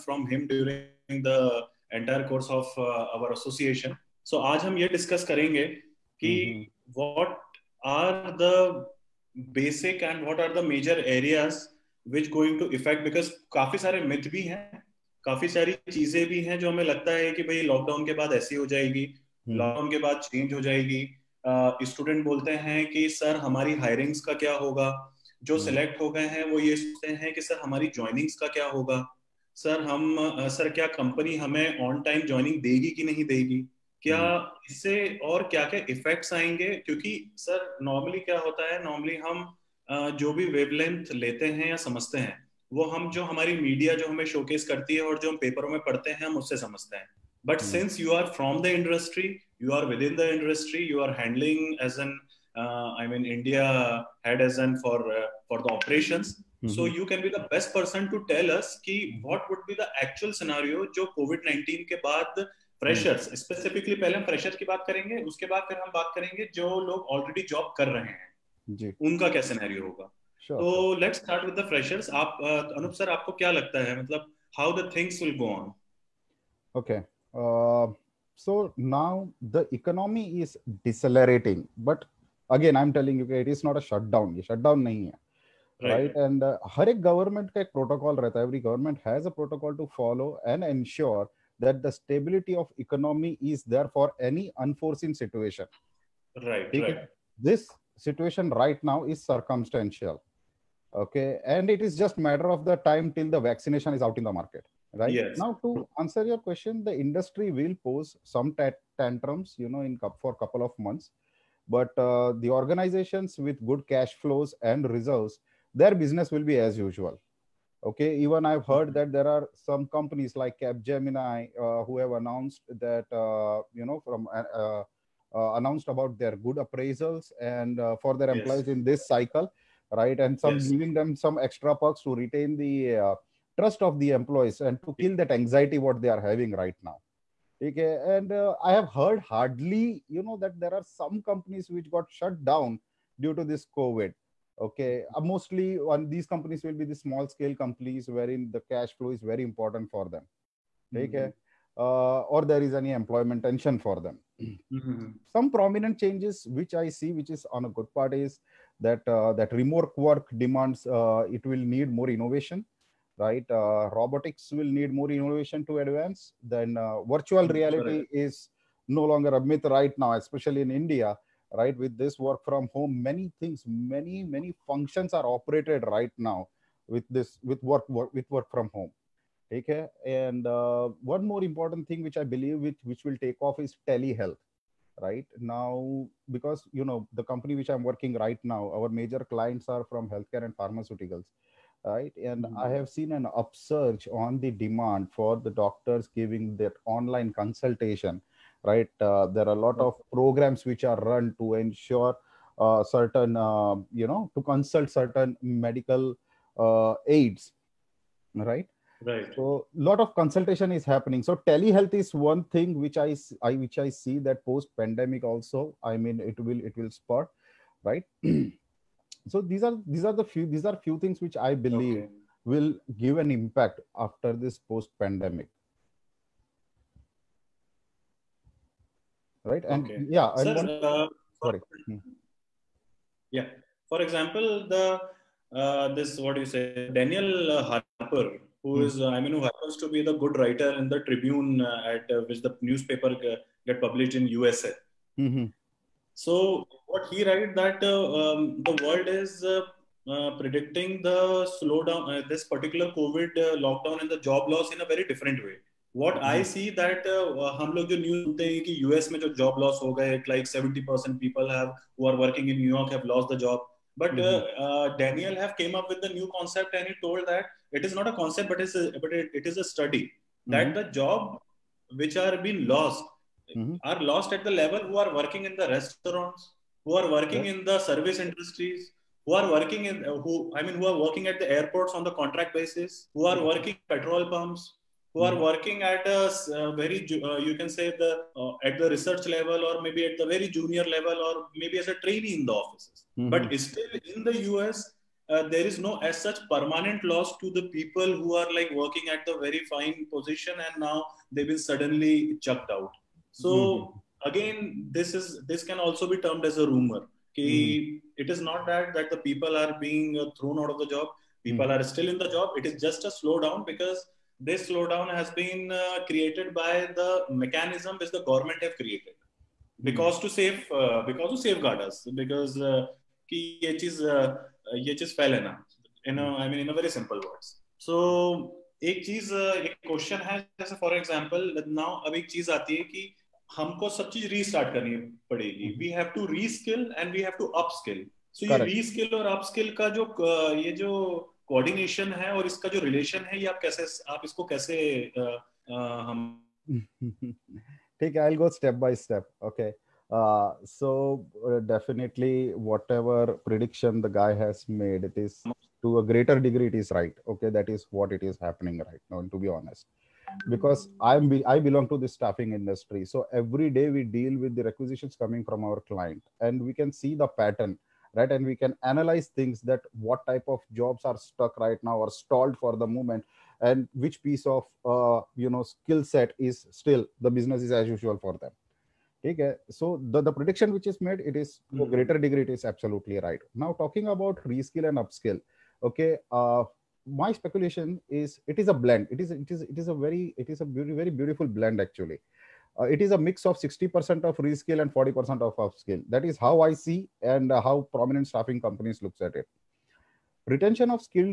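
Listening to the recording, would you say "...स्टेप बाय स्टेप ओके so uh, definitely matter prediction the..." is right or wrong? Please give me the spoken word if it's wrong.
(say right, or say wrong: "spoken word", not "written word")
wrong: "whatever", not "matter".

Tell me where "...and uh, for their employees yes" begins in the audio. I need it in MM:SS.
02:07.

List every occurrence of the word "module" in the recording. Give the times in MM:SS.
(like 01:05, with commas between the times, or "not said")
not said.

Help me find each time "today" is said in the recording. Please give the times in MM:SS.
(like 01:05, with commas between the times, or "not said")
00:04.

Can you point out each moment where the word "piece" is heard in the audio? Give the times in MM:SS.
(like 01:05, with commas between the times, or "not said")
06:14.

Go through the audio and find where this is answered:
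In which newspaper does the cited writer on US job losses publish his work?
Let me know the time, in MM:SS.
04:00.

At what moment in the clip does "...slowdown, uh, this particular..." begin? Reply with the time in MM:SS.
04:11.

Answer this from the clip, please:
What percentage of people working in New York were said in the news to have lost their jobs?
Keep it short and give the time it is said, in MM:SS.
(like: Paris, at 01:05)
70%, at 04:20.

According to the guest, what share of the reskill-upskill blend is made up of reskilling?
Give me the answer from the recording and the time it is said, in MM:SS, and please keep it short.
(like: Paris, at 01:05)
60%, at 06:33.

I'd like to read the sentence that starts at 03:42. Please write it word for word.
will give an impact after this post pandemic.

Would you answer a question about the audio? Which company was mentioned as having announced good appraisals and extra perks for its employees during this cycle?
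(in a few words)
Capgemini.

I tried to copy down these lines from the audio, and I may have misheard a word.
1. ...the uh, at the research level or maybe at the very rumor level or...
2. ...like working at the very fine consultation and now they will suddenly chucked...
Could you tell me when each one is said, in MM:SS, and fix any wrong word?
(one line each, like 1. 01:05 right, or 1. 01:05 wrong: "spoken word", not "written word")
1. 04:48 wrong: "junior", not "rumor"
2. 04:58 wrong: "position", not "consultation".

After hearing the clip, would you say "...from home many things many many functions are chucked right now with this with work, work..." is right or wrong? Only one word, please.
wrong.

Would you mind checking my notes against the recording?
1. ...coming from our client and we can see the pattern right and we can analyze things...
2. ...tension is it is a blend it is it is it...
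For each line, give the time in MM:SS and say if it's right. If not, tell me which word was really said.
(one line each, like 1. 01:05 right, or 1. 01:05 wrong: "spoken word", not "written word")
1. 06:05 right
2. 06:27 wrong: "speculation", not "tension".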